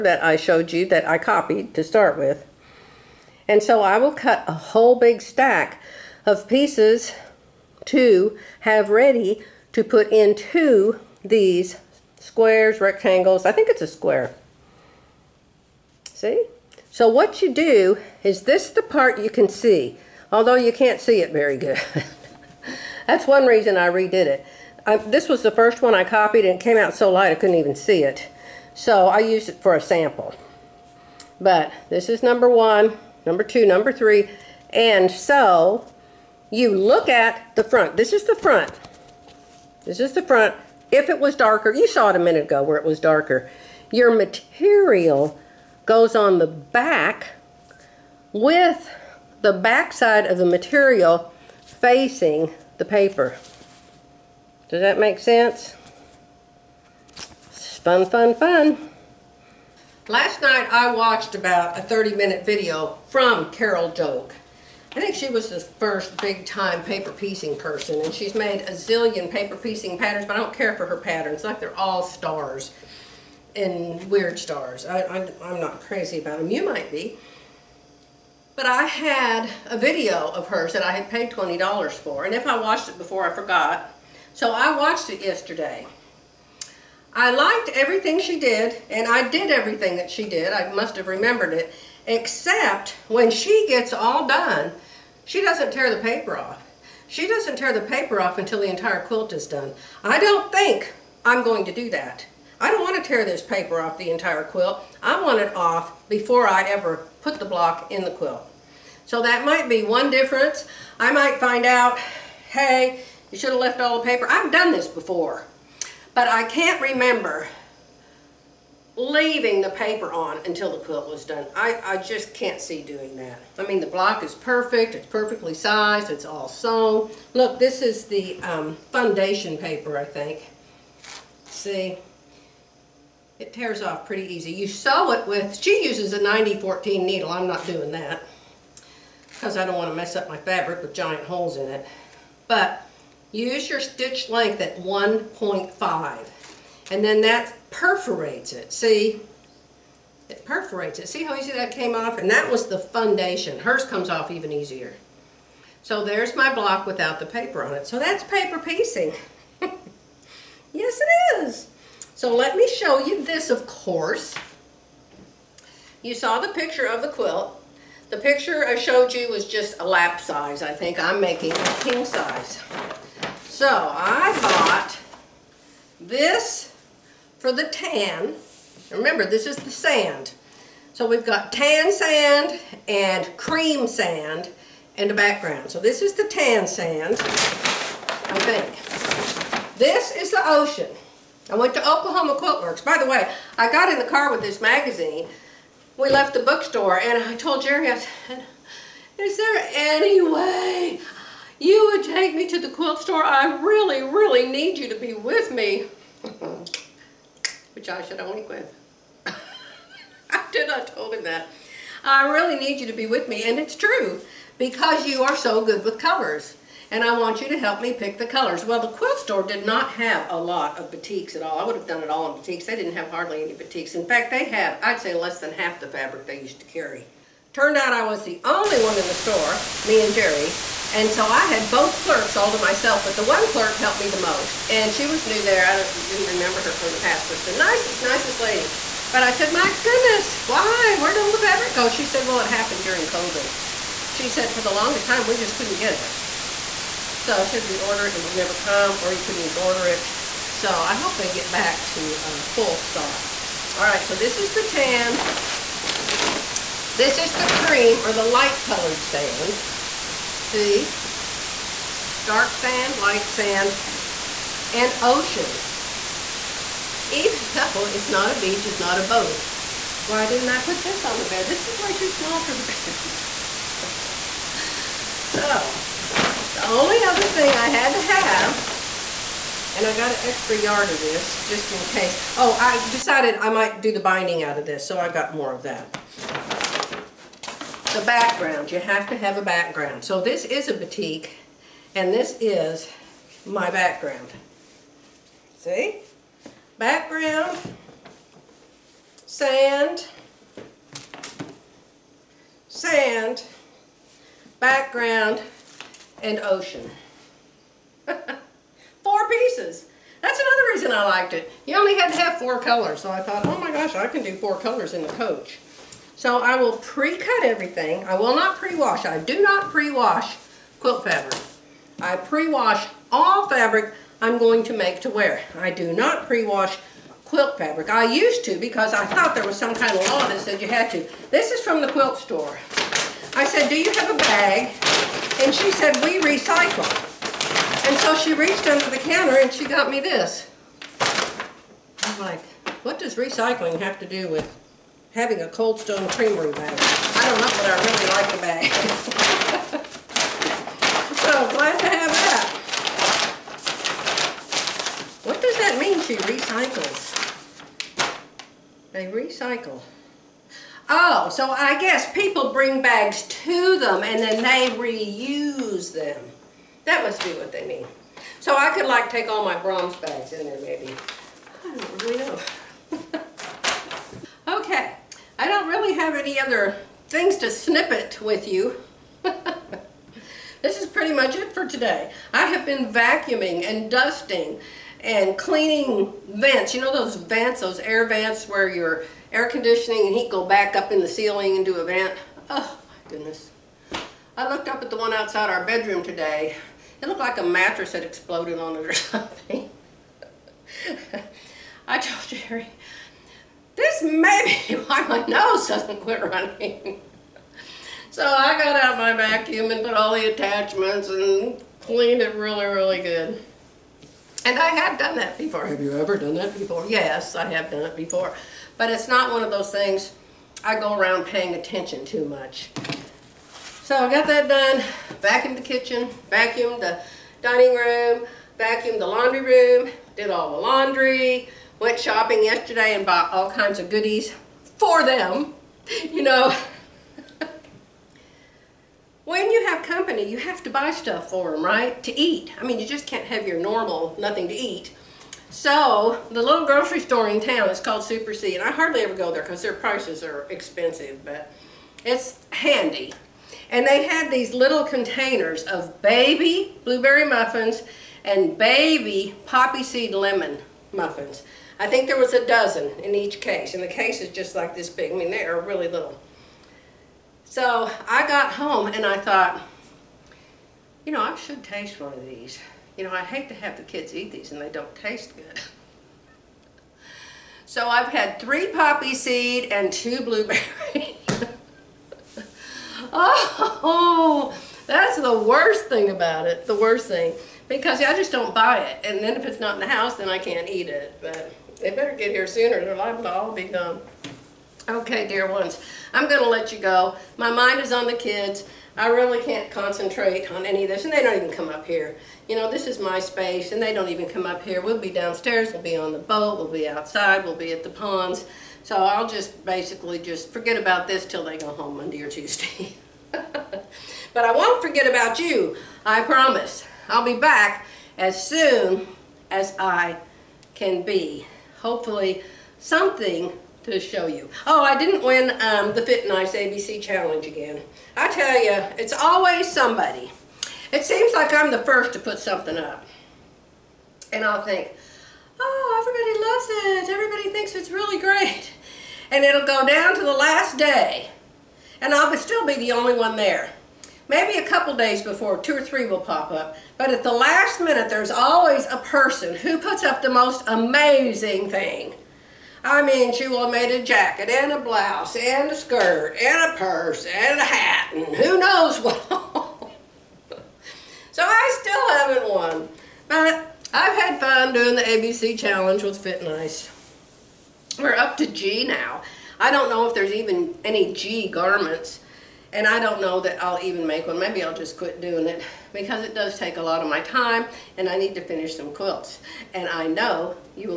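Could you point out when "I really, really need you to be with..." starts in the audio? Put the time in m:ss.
3:23.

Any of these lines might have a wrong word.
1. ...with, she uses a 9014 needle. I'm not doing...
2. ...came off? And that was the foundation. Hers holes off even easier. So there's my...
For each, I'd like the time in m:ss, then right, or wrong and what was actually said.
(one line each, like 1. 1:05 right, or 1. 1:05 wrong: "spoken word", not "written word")
1. 2:15 right
2. 2:31 wrong: "comes", not "holes".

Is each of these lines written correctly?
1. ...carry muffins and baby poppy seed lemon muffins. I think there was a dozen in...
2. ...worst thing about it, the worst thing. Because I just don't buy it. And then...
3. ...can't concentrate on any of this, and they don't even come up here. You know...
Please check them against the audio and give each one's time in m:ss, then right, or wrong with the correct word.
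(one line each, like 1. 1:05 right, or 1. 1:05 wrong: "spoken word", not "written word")
1. 7:36 wrong: "blueberry", not "carry"
2. 8:05 right
3. 8:19 right.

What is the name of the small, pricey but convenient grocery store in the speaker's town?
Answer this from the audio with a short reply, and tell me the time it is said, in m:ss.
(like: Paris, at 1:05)
Super C, at 7:28.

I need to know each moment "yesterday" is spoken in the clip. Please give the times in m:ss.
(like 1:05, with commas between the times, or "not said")
1:25, 7:12.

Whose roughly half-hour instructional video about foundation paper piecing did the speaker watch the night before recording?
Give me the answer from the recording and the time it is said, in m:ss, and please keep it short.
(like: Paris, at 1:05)
Carol Doak, at 1:03.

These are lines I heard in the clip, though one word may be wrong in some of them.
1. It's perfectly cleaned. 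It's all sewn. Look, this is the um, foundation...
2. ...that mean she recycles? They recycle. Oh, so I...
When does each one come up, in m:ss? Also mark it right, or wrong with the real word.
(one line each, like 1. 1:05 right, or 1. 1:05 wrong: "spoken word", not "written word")
1. 2:04 wrong: "sized", not "cleaned"
2. 5:55 right.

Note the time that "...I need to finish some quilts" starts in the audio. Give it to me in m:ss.
9:38.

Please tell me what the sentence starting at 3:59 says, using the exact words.
But I said, my goodness, why?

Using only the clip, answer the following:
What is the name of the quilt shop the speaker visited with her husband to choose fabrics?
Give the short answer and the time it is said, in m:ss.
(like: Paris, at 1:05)
Oklahoma Quilt Works, at 3:11.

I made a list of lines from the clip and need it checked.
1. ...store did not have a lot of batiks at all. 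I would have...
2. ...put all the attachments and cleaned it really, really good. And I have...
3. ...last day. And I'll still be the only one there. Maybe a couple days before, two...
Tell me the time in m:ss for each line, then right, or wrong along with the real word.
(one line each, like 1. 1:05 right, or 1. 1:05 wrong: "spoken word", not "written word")
1. 3:39 right
2. 6:49 right
3. 9:00 right.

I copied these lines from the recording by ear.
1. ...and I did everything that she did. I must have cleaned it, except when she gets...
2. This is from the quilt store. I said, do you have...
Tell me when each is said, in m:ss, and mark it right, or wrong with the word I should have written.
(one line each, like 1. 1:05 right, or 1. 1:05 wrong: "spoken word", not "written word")
1. 1:28 wrong: "remembered", not "cleaned"
2. 5:31 right.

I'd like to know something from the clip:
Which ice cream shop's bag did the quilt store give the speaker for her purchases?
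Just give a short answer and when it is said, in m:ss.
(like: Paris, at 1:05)
Cold Stone Creamery, at 5:45.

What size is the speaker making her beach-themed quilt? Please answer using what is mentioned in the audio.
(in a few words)
King size.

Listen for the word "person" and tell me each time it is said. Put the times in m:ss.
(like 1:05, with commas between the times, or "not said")
1:07, 9:08.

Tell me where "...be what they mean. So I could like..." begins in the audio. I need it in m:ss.
6:07.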